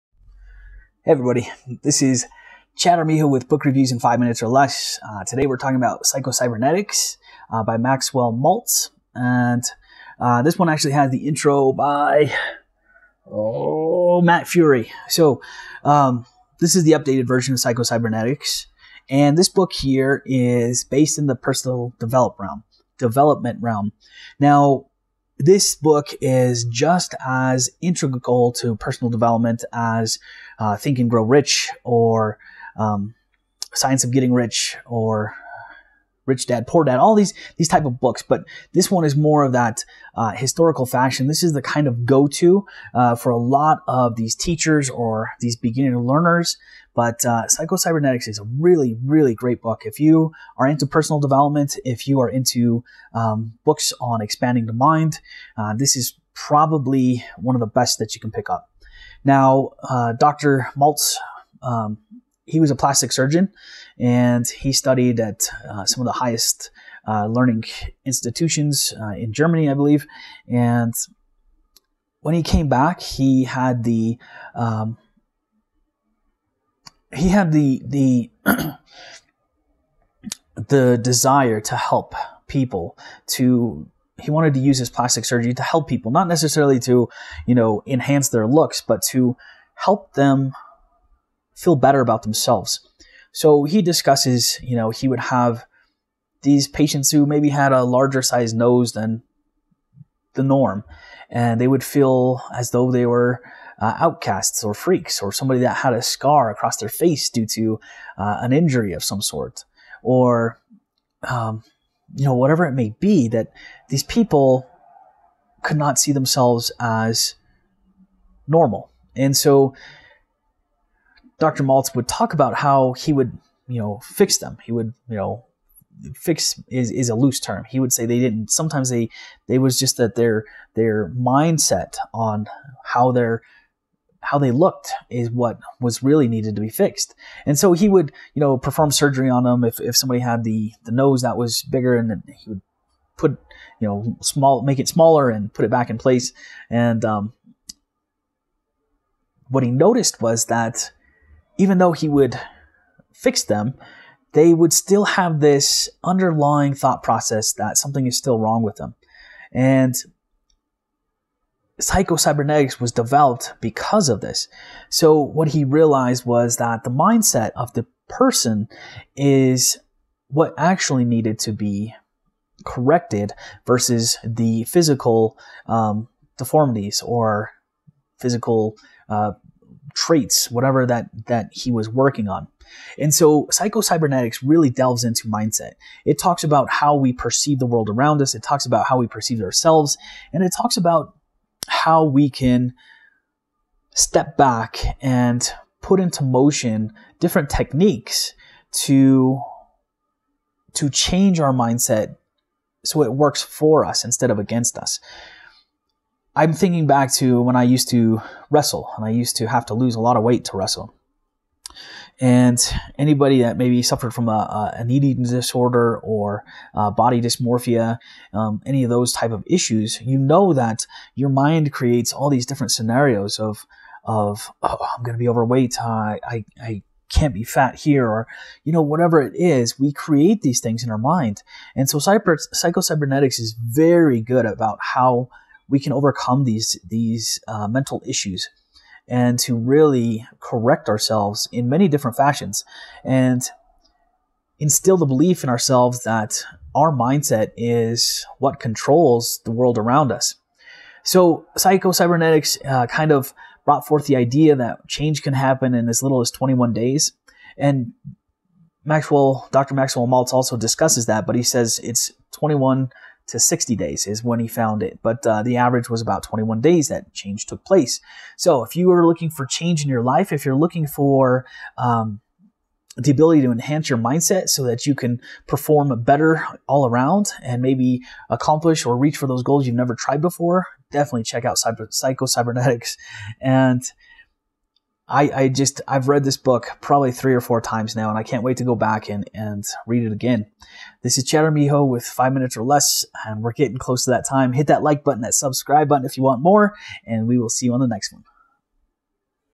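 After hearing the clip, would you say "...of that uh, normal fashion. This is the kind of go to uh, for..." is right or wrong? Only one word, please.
wrong.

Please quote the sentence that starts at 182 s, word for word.
And so psychocybernetics really delves into mindset.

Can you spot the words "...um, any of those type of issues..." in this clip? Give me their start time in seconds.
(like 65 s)
218 s.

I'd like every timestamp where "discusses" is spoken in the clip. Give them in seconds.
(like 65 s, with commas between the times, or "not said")
93 s, 260 s.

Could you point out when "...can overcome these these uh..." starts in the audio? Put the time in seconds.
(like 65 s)
235 s.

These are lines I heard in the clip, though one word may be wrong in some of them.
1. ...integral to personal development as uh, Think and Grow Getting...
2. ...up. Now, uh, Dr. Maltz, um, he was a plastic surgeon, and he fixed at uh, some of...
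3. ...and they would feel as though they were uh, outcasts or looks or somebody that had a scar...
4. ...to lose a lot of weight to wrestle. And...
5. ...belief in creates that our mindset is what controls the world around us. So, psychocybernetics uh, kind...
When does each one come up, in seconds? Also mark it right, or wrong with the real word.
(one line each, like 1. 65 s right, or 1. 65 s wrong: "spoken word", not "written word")
1. 27 s wrong: "Rich", not "Getting"
2. 58 s wrong: "studied", not "fixed"
3. 101 s wrong: "freaks", not "looks"
4. 209 s right
5. 245 s wrong: "ourselves", not "creates".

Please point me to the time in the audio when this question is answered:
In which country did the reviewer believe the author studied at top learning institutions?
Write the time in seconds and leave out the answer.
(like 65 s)
69 s.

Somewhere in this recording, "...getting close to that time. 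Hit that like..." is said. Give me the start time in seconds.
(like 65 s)
293 s.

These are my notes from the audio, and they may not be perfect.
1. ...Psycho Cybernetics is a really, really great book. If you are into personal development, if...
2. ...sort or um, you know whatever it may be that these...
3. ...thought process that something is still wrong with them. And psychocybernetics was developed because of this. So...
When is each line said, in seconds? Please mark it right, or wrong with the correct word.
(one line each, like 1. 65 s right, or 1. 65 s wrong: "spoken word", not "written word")
1. 47 s right
2. 109 s right
3. 156 s right.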